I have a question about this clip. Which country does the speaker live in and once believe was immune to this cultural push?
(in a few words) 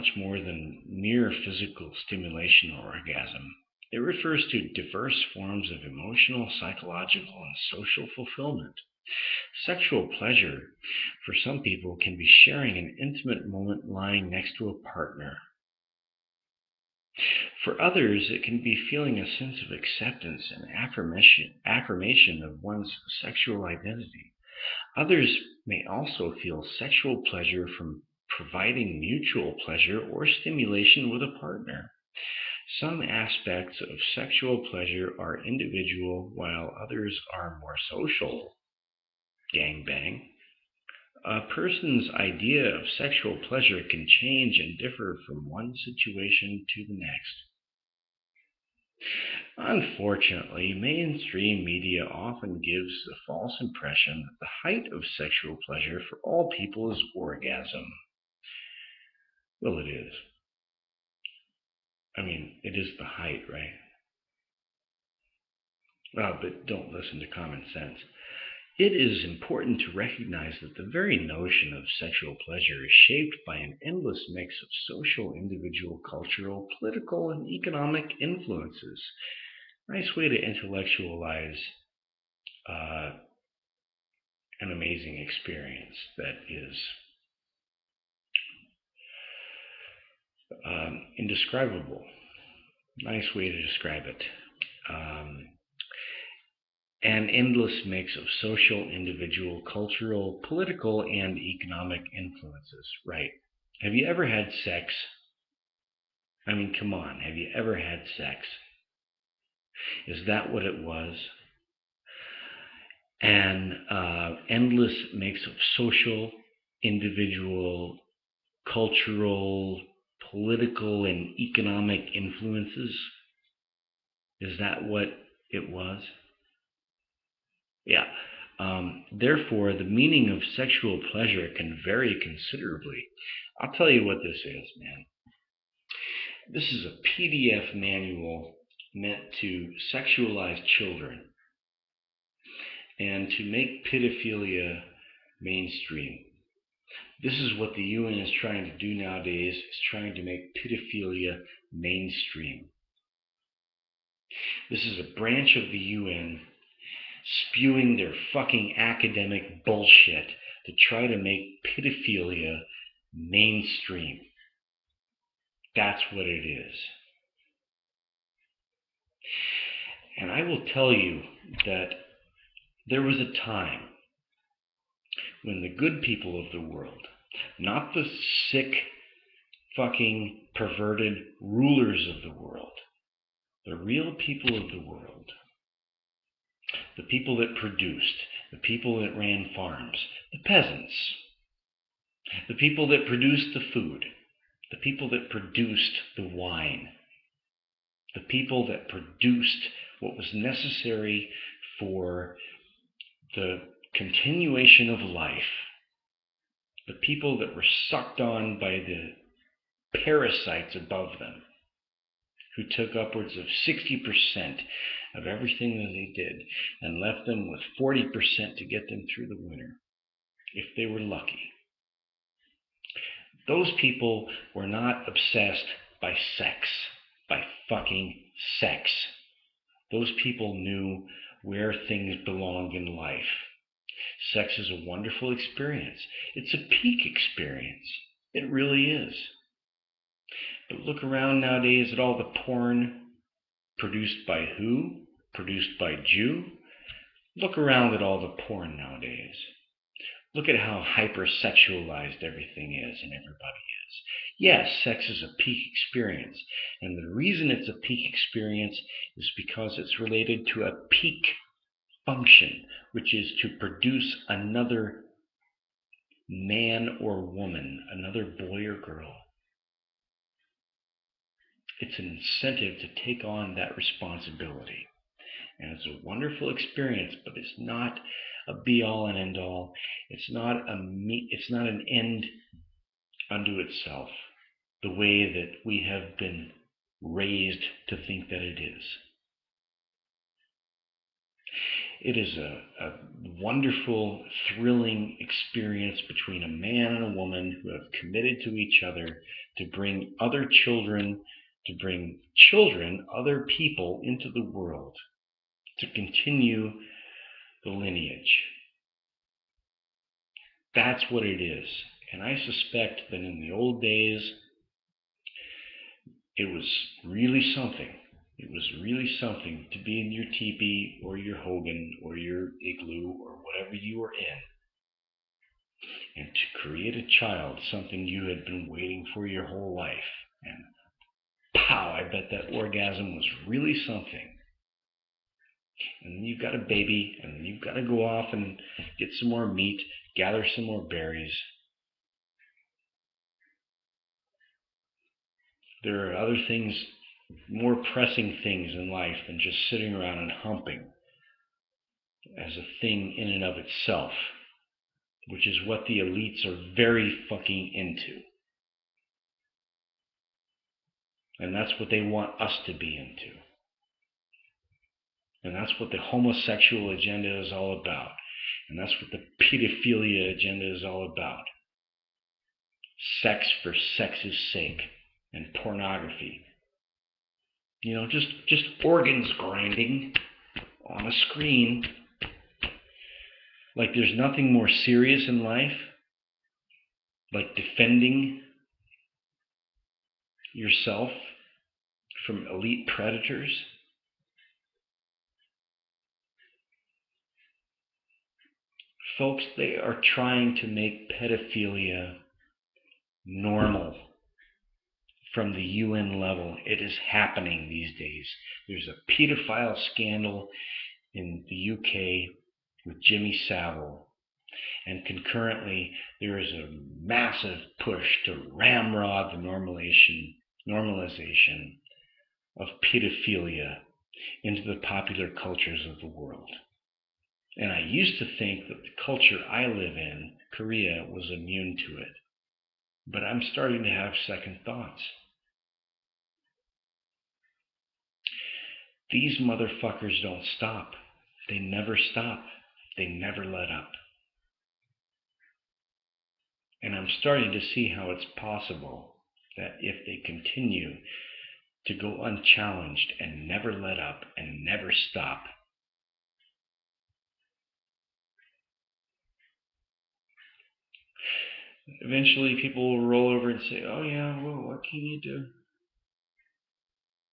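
Korea.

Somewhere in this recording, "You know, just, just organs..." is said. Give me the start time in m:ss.
6:17.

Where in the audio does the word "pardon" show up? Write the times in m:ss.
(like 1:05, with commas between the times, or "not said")
not said.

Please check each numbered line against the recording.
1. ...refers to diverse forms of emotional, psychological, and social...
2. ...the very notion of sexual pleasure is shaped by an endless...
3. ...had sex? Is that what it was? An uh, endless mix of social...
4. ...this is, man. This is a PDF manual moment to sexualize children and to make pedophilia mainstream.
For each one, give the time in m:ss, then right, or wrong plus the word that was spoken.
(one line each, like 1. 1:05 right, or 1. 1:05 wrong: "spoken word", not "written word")
1. 0:03 right
2. 1:10 right
3. 1:47 right
4. 2:14 wrong: "meant", not "moment".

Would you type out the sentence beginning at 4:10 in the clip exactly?
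Look at how hypersexualized everything is and everybody is.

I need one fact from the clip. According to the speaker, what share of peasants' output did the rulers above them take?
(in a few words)
60%.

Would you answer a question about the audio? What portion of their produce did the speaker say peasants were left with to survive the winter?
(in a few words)
40%.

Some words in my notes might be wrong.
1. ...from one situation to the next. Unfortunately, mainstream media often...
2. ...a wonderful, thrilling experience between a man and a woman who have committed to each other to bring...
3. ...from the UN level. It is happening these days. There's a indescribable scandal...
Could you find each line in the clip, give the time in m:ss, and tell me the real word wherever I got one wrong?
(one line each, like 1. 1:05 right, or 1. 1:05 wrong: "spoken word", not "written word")
1. 0:45 right
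2. 4:52 right
3. 6:45 wrong: "pedophile", not "indescribable".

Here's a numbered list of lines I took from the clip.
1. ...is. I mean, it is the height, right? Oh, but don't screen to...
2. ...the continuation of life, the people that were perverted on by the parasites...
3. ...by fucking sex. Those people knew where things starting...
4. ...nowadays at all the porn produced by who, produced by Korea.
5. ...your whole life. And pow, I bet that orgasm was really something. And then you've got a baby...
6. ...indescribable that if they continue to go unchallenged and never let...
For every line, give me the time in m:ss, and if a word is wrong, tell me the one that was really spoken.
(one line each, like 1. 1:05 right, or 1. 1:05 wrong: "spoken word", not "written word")
1. 0:59 wrong: "listen", not "screen"
2. 3:23 wrong: "sucked", not "perverted"
3. 3:47 wrong: "belong", not "starting"
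4. 4:01 wrong: "Jew", not "Korea"
5. 5:29 right
6. 7:28 wrong: "possible", not "indescribable".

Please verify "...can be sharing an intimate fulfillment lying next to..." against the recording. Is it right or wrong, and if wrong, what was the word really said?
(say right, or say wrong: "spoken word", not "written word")
wrong: "moment", not "fulfillment".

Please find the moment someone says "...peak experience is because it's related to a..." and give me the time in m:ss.
4:17.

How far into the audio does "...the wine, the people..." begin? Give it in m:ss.
3:16.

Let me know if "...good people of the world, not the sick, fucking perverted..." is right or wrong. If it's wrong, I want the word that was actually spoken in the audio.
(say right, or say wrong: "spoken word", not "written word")
right.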